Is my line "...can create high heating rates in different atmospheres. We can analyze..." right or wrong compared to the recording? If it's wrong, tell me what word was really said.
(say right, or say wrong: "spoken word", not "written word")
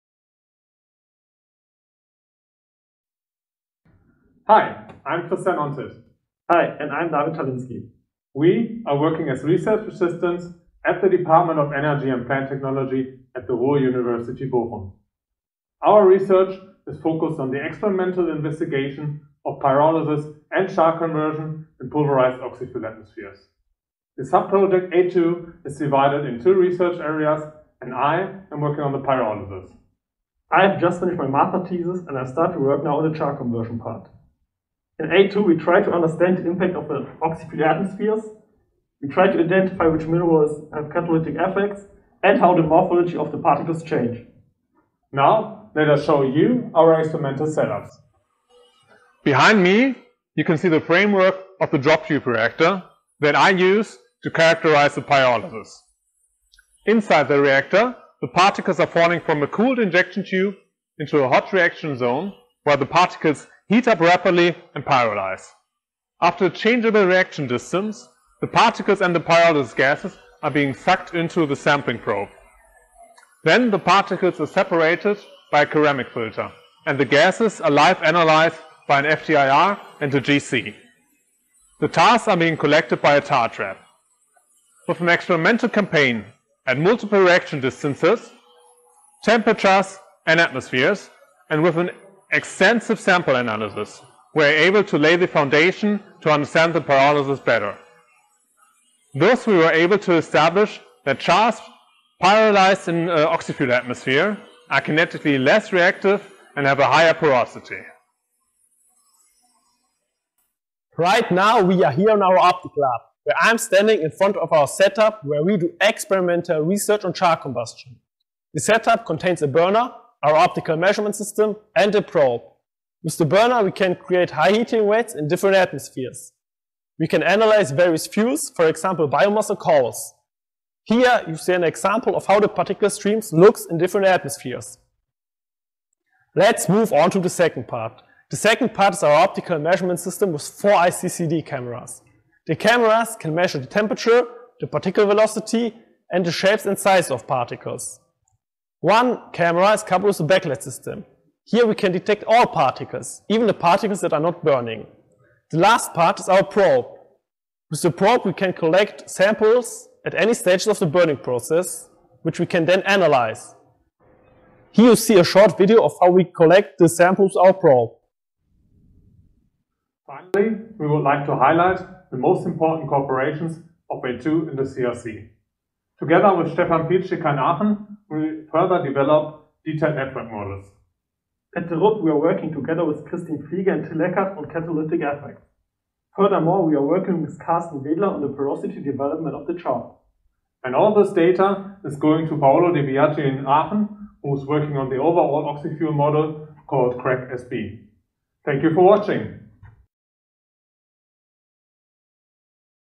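right.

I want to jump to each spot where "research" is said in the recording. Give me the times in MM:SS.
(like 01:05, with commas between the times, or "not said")
00:09, 00:16, 00:26, 01:56.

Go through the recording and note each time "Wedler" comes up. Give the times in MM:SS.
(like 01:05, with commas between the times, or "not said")
03:07.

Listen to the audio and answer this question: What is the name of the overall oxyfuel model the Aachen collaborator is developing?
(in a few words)
CRECK-SB.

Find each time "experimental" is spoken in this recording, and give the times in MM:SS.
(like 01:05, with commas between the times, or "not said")
00:17, 00:46, 01:25, 01:55.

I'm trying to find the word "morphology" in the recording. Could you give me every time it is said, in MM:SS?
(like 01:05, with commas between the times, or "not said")
00:42.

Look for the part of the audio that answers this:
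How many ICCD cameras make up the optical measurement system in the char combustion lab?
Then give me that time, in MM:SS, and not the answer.
02:20.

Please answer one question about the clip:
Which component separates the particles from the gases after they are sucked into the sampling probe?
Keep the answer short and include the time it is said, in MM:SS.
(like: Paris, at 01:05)
Ceramic filter, at 01:15.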